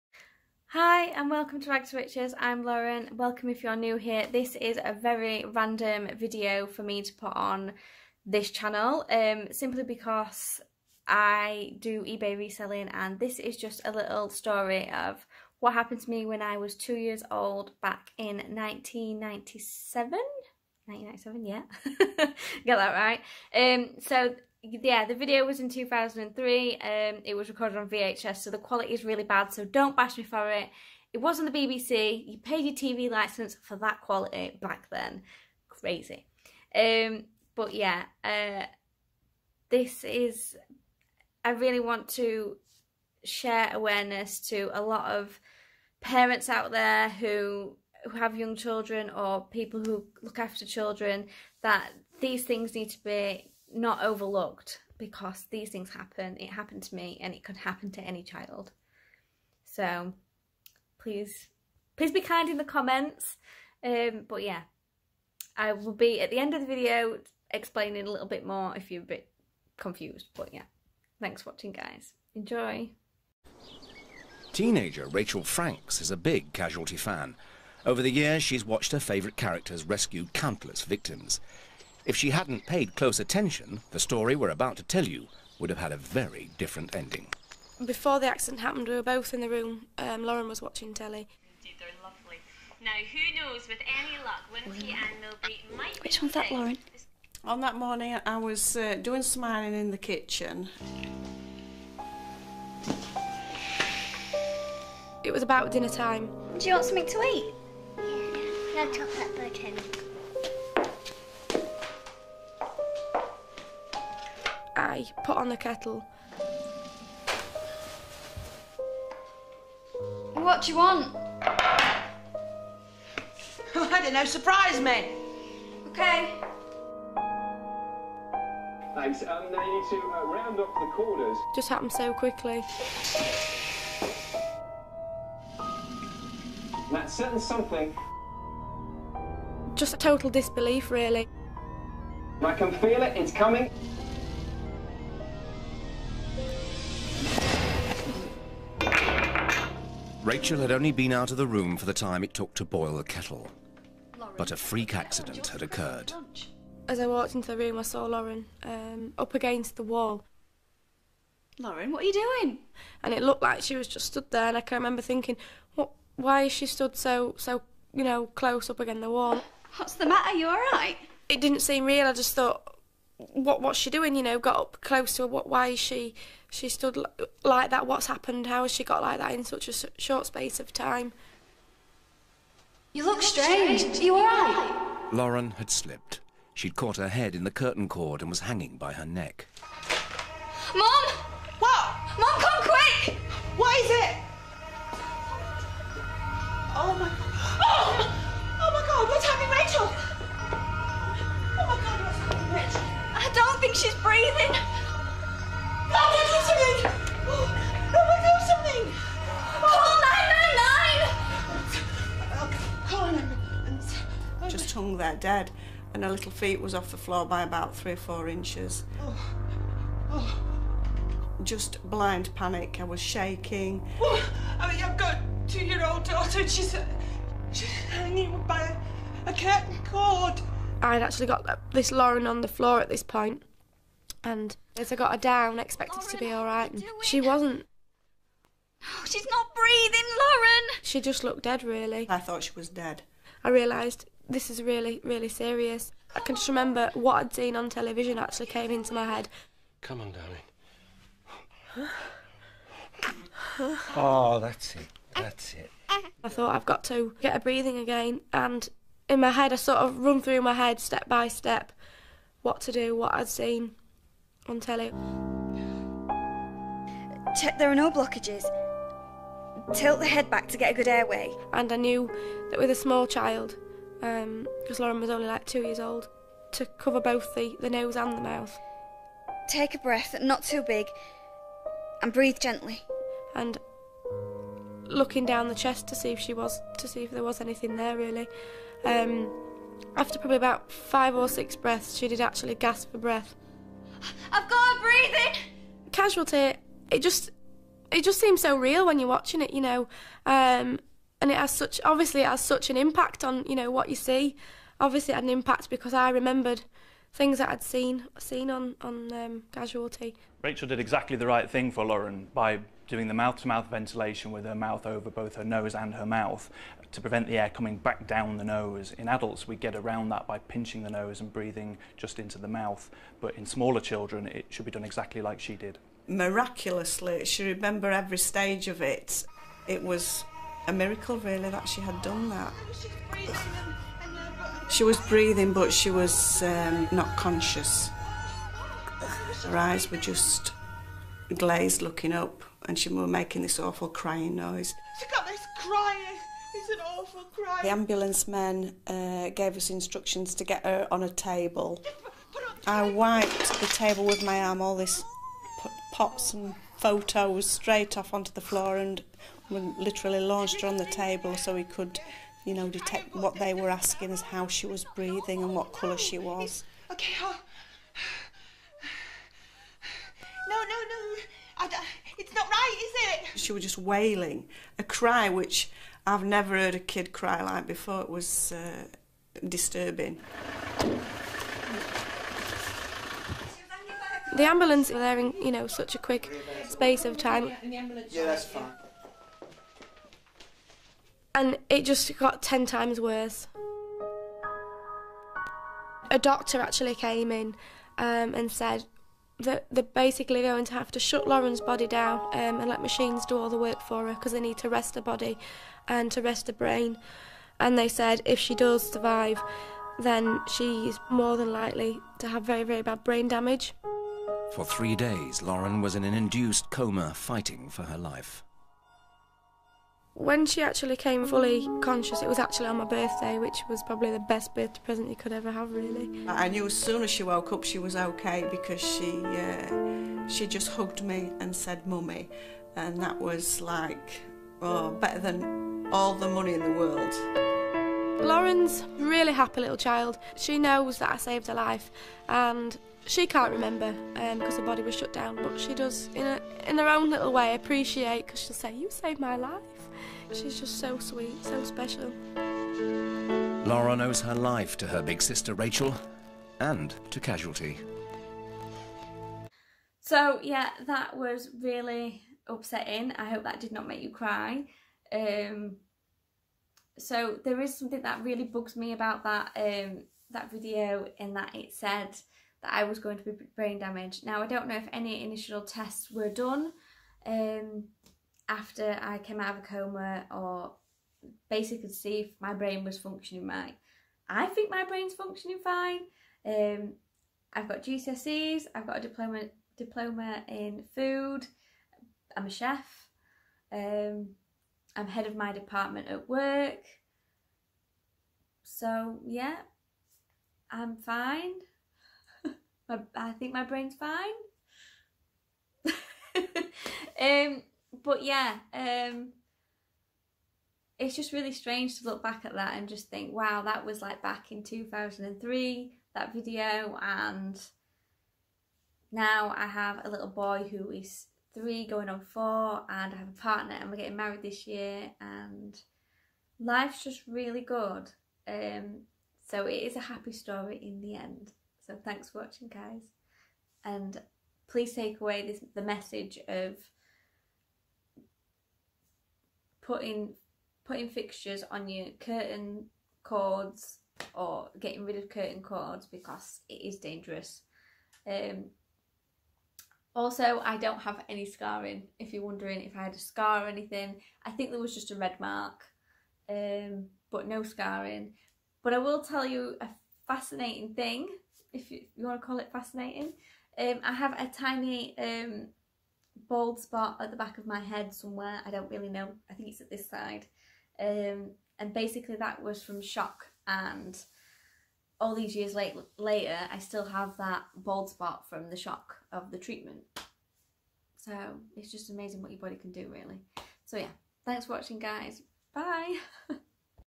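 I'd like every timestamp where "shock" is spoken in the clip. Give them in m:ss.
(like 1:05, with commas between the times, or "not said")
9:33, 9:38.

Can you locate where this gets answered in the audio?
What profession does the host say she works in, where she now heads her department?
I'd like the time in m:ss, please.
8:12.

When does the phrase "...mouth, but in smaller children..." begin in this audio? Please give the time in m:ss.
5:22.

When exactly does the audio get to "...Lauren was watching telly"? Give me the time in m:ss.
1:30.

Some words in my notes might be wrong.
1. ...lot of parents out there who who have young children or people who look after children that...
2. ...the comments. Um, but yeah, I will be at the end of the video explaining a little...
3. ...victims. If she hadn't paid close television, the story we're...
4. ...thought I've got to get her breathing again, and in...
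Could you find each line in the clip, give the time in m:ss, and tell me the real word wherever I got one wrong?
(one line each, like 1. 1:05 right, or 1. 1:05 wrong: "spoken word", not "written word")
1. 0:44 right
2. 1:02 right
3. 1:20 wrong: "attention", not "television"
4. 4:16 right.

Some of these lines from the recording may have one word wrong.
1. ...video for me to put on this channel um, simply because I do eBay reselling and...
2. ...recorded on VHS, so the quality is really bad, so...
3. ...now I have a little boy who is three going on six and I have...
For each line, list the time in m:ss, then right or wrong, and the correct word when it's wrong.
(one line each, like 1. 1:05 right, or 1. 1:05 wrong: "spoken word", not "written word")
1. 0:06 right
2. 0:27 right
3. 8:39 wrong: "four", not "six".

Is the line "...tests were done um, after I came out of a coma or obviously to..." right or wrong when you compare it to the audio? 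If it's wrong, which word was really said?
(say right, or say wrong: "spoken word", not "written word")
wrong: "basically", not "obviously".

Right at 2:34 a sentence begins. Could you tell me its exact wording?
But a freak accident had occurred.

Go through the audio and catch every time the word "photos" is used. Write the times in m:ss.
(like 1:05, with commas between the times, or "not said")
5:56.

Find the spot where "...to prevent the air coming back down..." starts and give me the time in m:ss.
5:16.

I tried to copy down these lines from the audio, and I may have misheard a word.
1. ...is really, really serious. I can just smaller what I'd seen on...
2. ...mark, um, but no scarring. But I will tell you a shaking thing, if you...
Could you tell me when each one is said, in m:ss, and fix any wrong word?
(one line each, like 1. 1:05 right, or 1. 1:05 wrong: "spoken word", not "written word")
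1. 4:04 wrong: "remember", not "smaller"
2. 9:15 wrong: "fascinating", not "shaking".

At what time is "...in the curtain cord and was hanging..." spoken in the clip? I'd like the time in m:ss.
3:07.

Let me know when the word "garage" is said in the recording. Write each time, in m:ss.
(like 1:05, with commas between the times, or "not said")
not said.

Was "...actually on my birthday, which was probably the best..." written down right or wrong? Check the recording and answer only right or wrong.
right.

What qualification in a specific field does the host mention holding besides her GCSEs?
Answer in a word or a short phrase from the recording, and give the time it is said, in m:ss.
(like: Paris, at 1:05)
Diploma in food, at 8:09.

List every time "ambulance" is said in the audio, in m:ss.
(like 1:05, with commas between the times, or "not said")
5:47, 6:24.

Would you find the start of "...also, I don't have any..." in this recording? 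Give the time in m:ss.
9:10.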